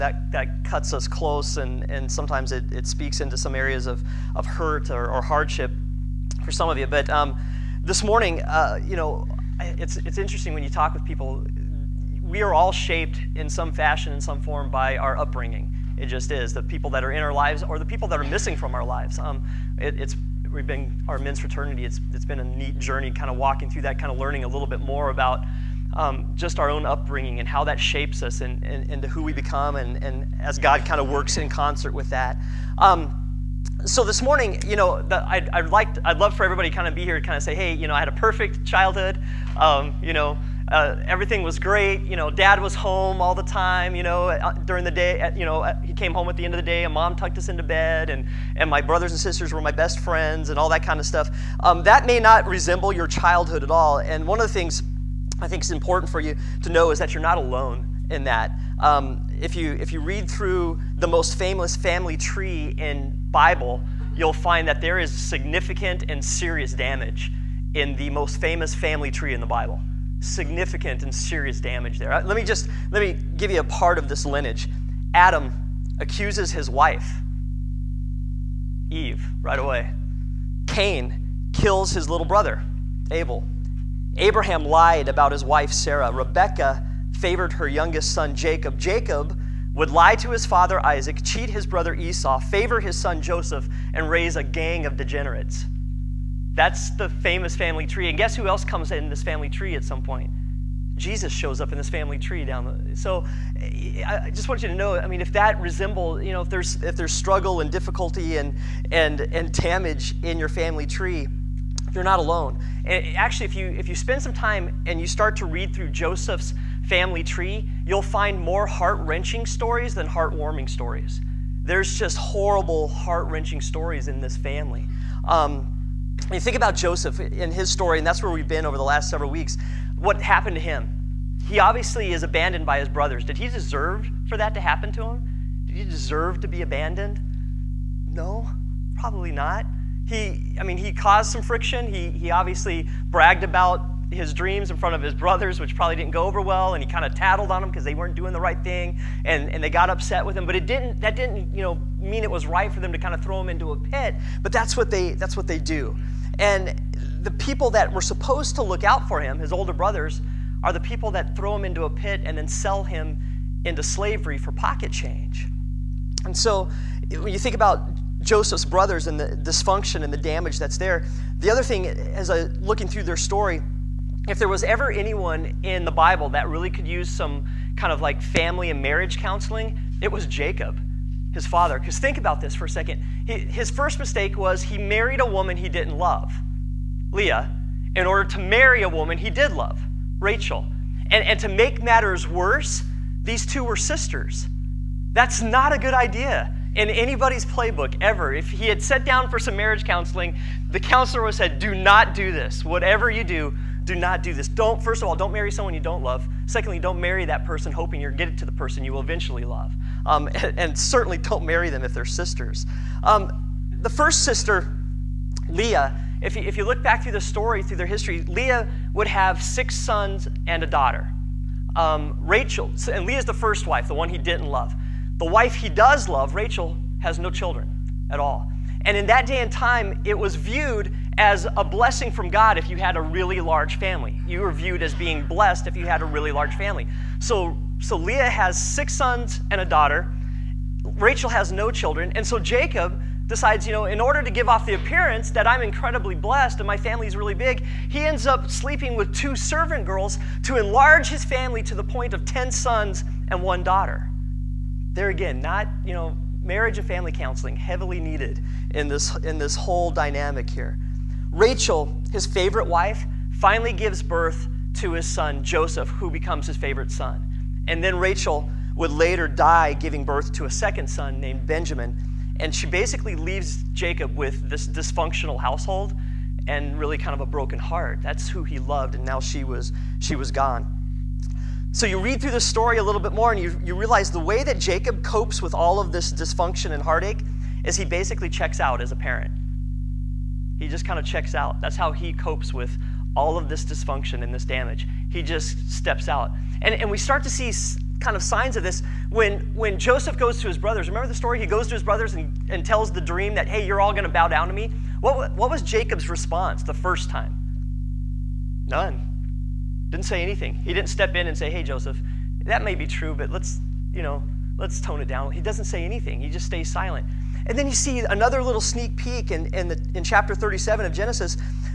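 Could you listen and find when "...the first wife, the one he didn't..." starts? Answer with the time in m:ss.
3:43.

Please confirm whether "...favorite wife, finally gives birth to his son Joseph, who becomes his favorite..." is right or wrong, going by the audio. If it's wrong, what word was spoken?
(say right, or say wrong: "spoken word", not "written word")
right.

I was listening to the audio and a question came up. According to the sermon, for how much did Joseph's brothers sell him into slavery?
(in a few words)
pocket change.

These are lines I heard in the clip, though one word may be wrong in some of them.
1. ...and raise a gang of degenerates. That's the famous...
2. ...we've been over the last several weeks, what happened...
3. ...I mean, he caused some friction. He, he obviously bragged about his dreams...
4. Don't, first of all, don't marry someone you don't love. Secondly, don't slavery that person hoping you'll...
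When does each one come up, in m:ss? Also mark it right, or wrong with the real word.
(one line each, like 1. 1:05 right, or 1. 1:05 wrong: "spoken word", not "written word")
1. 1:33 right
2. 2:08 right
3. 2:20 right
4. 3:24 wrong: "marry", not "slavery".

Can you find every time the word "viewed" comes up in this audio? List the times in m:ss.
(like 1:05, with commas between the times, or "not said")
3:50, 3:54.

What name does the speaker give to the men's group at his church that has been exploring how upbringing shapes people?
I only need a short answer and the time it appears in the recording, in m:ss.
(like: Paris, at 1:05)
men's fraternity, at 0:21.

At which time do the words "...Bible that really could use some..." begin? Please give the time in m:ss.
2:55.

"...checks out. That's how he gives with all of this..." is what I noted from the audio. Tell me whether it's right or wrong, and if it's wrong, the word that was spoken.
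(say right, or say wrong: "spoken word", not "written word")
wrong: "copes", not "gives".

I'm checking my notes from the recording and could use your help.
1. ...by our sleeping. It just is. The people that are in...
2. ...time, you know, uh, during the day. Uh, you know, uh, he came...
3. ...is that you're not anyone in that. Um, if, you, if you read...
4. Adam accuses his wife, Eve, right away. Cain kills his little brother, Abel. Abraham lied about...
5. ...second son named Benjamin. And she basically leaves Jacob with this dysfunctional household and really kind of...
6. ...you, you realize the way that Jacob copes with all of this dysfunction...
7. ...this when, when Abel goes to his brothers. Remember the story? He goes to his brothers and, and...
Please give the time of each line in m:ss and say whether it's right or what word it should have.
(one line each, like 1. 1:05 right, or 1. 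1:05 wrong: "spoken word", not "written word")
1. 0:14 wrong: "upbringing", not "sleeping"
2. 0:43 right
3. 0:56 wrong: "alone", not "anyone"
4. 1:15 right
5. 4:30 right
6. 4:43 right
7. 4:58 wrong: "Joseph", not "Abel".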